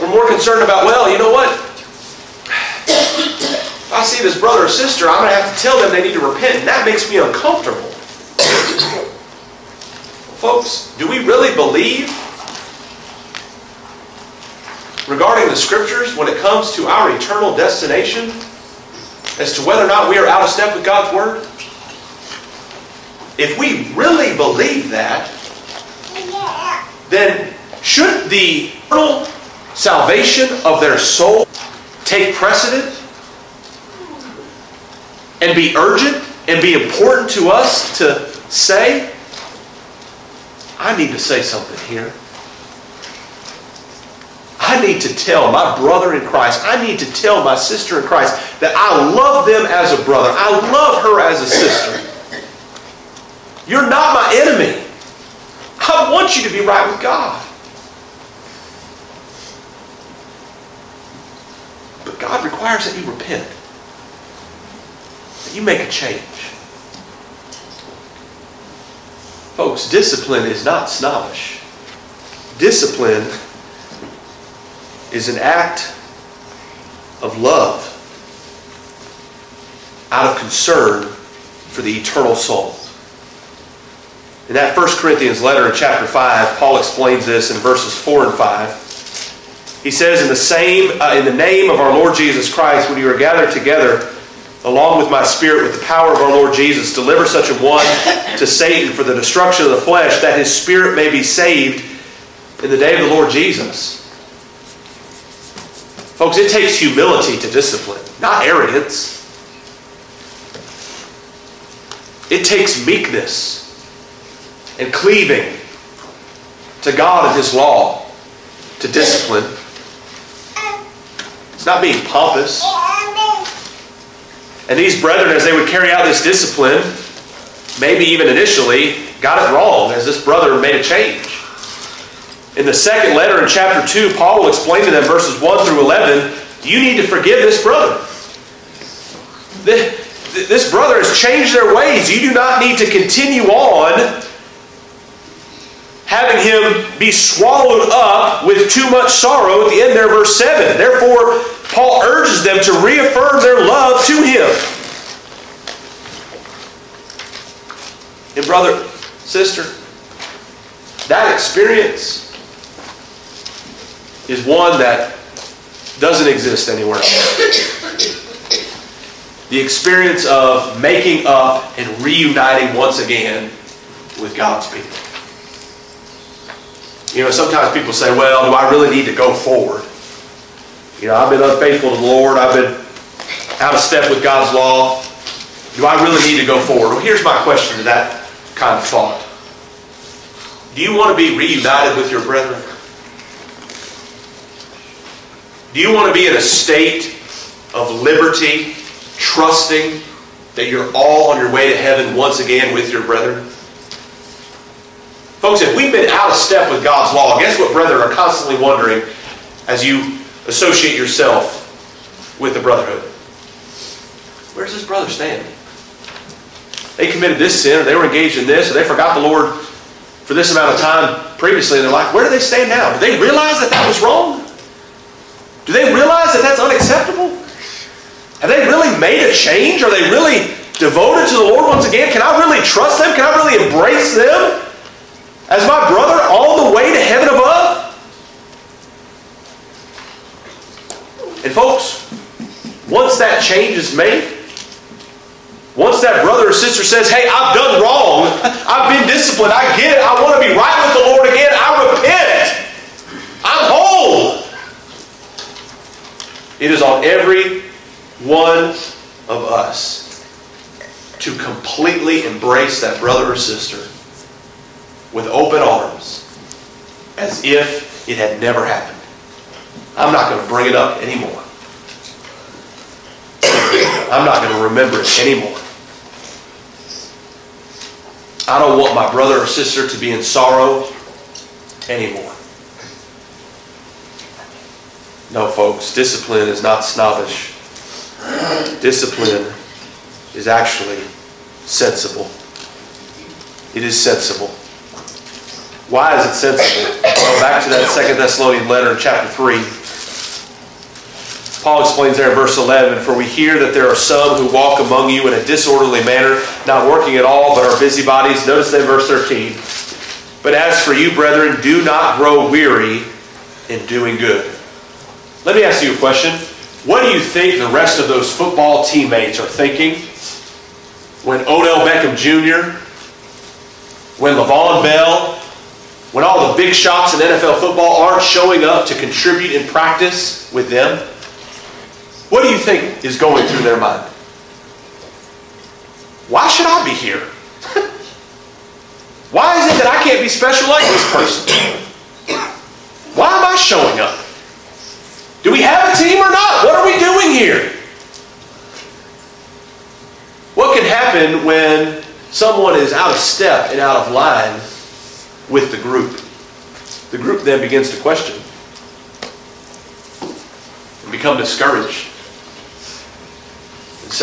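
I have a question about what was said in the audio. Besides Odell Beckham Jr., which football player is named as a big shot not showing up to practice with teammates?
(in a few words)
Le'Veon Bell.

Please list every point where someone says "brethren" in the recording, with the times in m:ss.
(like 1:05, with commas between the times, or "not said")
2:05, 3:12, 3:23, 3:27, 5:11.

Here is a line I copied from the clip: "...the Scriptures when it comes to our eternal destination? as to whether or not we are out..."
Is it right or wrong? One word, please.
right.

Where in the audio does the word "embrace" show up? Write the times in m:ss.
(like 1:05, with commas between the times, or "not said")
3:53, 4:22.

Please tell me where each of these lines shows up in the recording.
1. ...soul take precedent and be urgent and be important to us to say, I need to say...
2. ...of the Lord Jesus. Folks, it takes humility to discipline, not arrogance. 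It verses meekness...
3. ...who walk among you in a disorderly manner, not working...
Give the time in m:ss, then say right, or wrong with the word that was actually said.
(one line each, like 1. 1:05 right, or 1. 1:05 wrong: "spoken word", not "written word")
1. 0:30 right
2. 1:43 wrong: "takes", not "verses"
3. 5:04 right.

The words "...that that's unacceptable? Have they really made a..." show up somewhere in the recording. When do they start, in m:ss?
3:46.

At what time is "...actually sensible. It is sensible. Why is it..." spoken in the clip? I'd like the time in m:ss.
4:50.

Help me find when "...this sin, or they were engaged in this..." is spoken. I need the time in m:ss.
3:37.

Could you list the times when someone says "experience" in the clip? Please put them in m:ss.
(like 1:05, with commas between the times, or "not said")
2:41, 2:49.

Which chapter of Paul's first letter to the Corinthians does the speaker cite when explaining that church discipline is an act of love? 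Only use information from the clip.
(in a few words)
Chapter 5.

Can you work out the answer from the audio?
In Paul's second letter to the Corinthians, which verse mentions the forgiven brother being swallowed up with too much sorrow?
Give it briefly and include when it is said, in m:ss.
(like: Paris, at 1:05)
Verse 7, at 2:30.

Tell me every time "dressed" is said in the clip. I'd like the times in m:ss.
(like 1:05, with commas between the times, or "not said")
not said.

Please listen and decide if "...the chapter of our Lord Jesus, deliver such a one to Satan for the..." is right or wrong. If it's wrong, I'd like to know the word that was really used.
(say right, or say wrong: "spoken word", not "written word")
wrong: "power", not "chapter".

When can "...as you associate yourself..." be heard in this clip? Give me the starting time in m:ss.
3:29.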